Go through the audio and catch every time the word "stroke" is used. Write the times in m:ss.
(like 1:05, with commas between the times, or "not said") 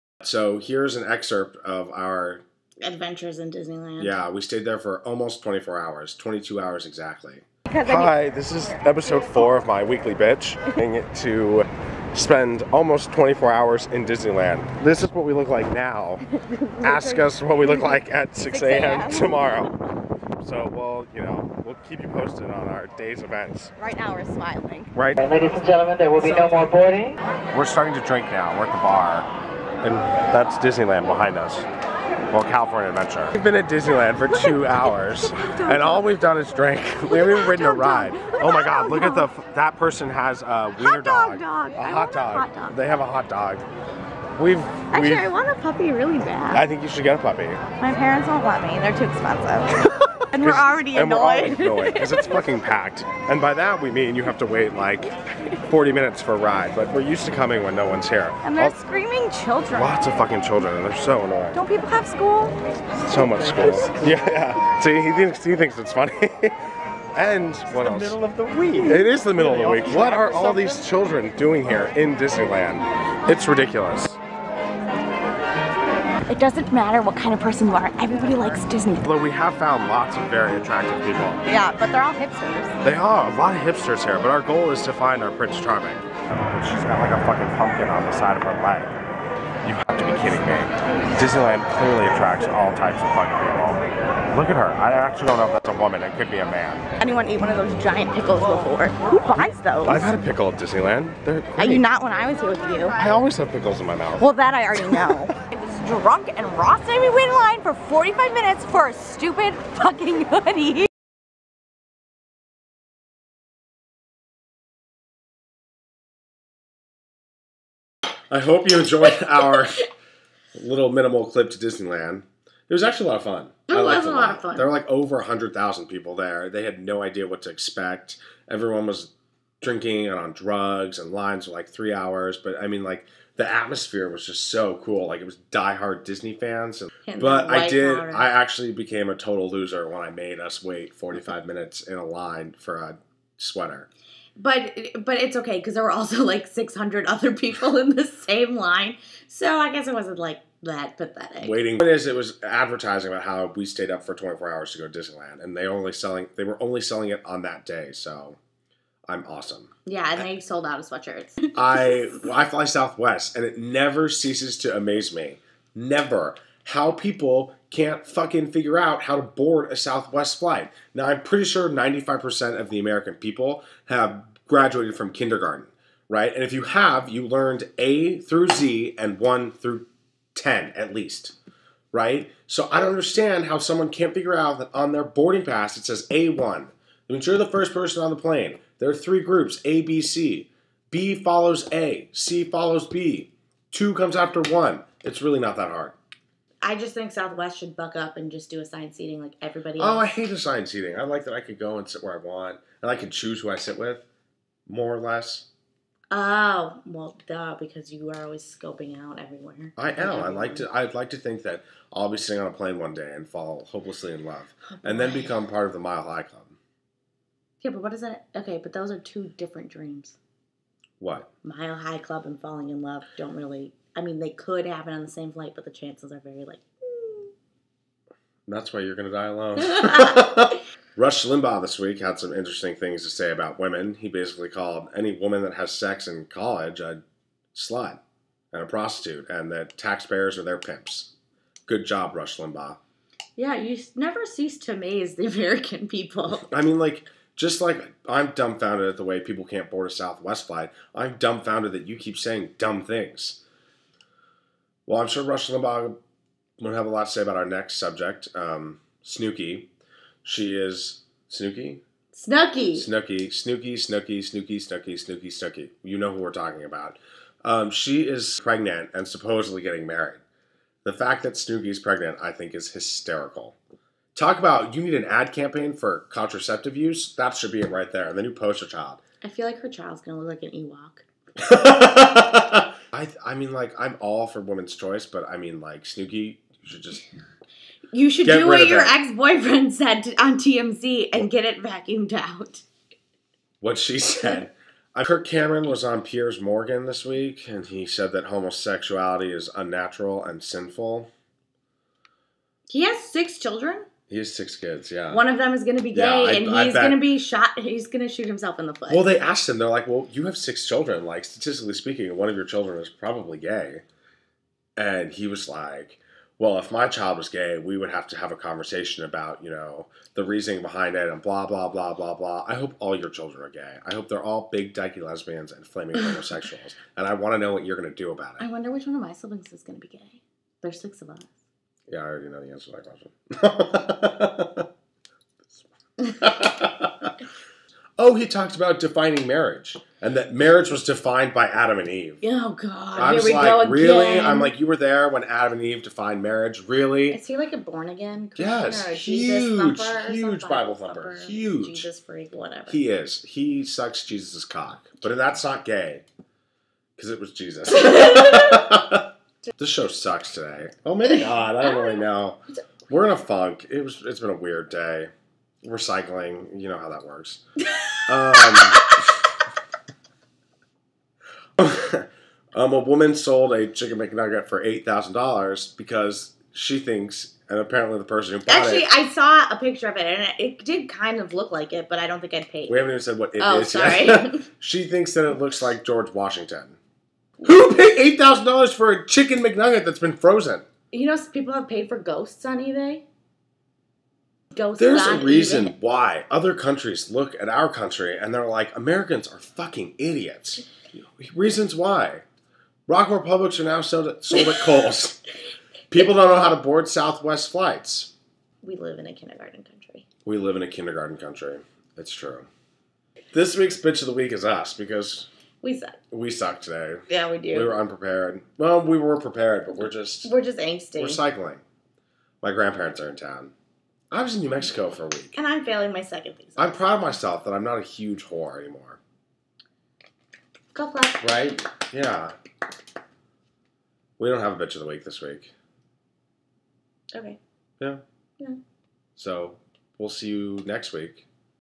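not said.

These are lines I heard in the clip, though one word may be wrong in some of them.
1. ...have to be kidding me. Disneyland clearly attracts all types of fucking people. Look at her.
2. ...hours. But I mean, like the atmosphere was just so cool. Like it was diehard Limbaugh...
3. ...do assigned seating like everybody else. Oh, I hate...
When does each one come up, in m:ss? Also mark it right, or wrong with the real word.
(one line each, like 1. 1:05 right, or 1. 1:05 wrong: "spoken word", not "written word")
1. 1:29 right
2. 2:11 wrong: "Disney", not "Limbaugh"
3. 3:18 right.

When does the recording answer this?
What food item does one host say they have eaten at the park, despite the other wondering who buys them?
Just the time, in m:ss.
1:40.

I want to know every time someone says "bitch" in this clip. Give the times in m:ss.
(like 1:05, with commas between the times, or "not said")
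0:10, 6:53, 7:14.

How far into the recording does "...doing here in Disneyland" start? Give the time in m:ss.
1:11.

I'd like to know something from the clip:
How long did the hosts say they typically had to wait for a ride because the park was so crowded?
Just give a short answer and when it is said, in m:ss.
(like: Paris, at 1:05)
40 minutes, at 0:55.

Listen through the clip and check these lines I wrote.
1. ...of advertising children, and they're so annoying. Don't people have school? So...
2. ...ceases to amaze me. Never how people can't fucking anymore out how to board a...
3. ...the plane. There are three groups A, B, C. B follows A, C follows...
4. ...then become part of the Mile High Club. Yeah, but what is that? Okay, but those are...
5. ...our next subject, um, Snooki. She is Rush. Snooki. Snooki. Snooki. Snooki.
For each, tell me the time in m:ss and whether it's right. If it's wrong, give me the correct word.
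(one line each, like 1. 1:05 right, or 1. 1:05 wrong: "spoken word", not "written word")
1. 1:00 wrong: "fucking", not "advertising"
2. 2:44 wrong: "figure", not "anymore"
3. 3:08 right
4. 3:34 right
5. 4:17 wrong: "Snooki", not "Rush".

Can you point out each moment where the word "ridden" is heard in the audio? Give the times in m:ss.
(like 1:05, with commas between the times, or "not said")
0:37.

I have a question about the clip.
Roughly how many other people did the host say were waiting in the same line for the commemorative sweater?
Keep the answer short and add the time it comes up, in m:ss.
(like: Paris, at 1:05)
600, at 2:26.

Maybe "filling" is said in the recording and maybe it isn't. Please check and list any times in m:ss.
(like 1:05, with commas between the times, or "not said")
not said.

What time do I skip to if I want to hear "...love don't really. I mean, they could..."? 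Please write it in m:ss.
3:42.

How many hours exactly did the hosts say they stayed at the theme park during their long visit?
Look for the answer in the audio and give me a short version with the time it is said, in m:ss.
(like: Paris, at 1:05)
22, at 0:06.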